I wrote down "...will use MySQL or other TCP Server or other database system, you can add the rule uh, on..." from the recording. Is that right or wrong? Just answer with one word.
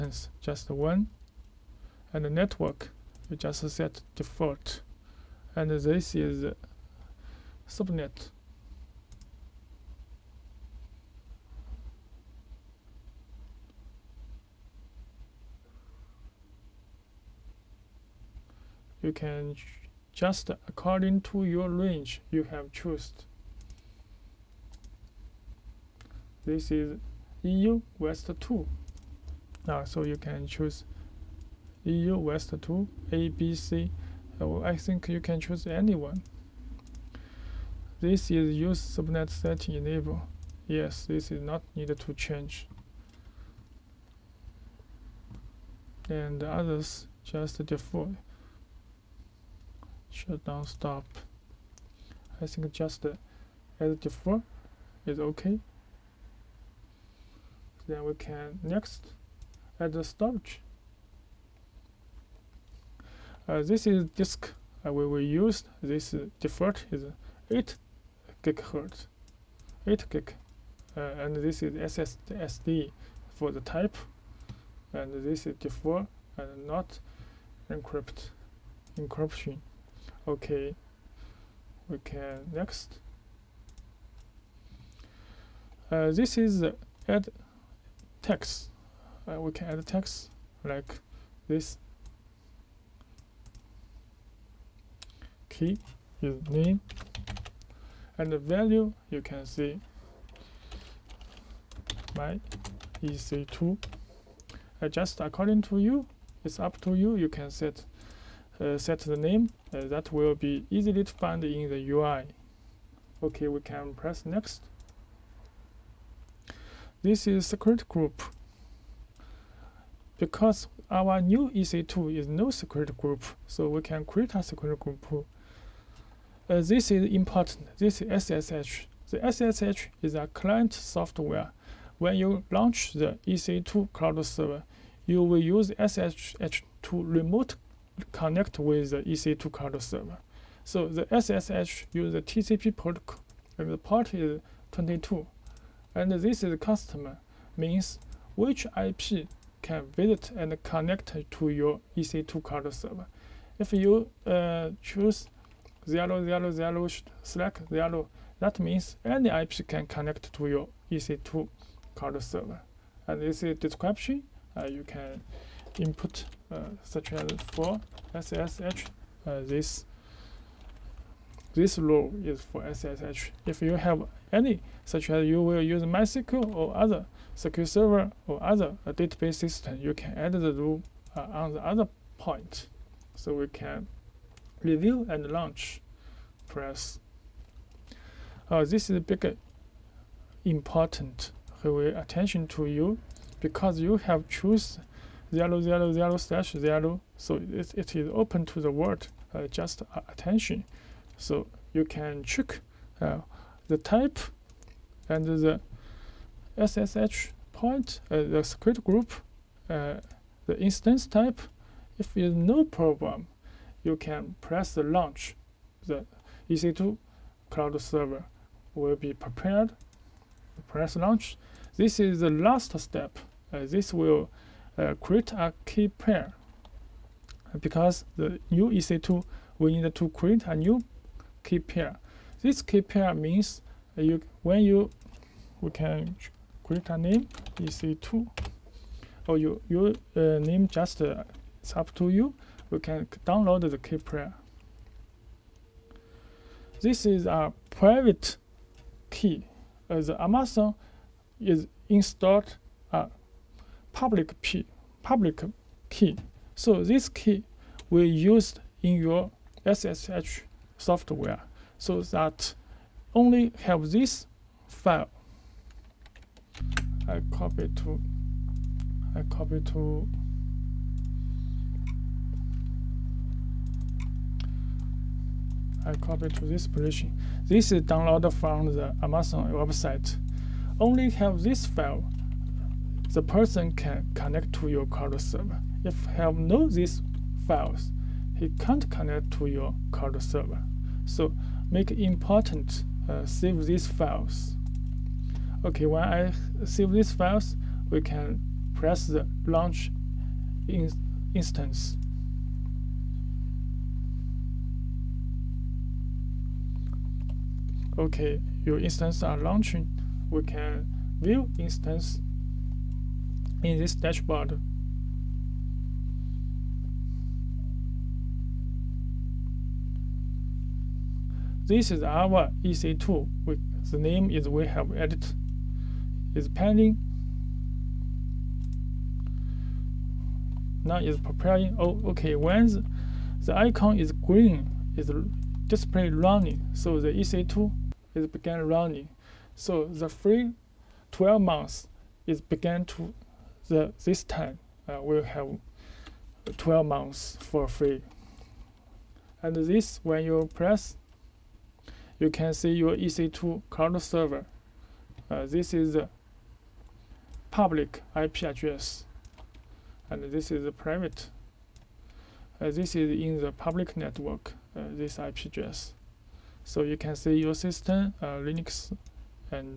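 wrong.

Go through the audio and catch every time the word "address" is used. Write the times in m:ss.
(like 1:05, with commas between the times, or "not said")
5:58, 6:05.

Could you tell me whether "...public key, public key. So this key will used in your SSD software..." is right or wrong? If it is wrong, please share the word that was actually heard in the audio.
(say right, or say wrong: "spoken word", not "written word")
wrong: "SSH", not "SSD".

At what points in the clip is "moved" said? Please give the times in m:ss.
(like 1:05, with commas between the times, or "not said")
not said.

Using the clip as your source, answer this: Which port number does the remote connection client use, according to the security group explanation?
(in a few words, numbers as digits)
22.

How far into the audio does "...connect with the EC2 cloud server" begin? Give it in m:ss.
2:18.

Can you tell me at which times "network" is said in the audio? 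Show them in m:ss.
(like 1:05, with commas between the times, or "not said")
0:02, 6:03.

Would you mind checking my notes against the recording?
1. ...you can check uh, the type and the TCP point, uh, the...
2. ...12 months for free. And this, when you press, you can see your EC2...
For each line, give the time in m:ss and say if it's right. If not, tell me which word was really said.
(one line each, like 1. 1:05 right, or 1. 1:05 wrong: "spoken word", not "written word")
1. 3:21 wrong: "SSH", not "TCP"
2. 5:46 right.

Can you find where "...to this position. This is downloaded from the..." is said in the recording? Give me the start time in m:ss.
4:36.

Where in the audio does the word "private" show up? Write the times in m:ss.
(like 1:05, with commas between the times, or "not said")
4:07, 6:00.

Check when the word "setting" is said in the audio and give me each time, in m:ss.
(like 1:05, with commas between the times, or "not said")
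0:39.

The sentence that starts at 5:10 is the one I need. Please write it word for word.
We can view instance in this dashboard.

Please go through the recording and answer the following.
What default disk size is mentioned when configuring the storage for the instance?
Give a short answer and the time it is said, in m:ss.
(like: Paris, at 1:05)
8 GB, at 1:09.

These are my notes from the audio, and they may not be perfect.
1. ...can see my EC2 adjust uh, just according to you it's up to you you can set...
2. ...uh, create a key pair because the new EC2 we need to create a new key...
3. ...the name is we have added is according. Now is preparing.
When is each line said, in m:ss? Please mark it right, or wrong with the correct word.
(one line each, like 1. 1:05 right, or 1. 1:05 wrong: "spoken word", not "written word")
1. 1:39 right
2. 3:44 right
3. 5:23 wrong: "pending", not "according".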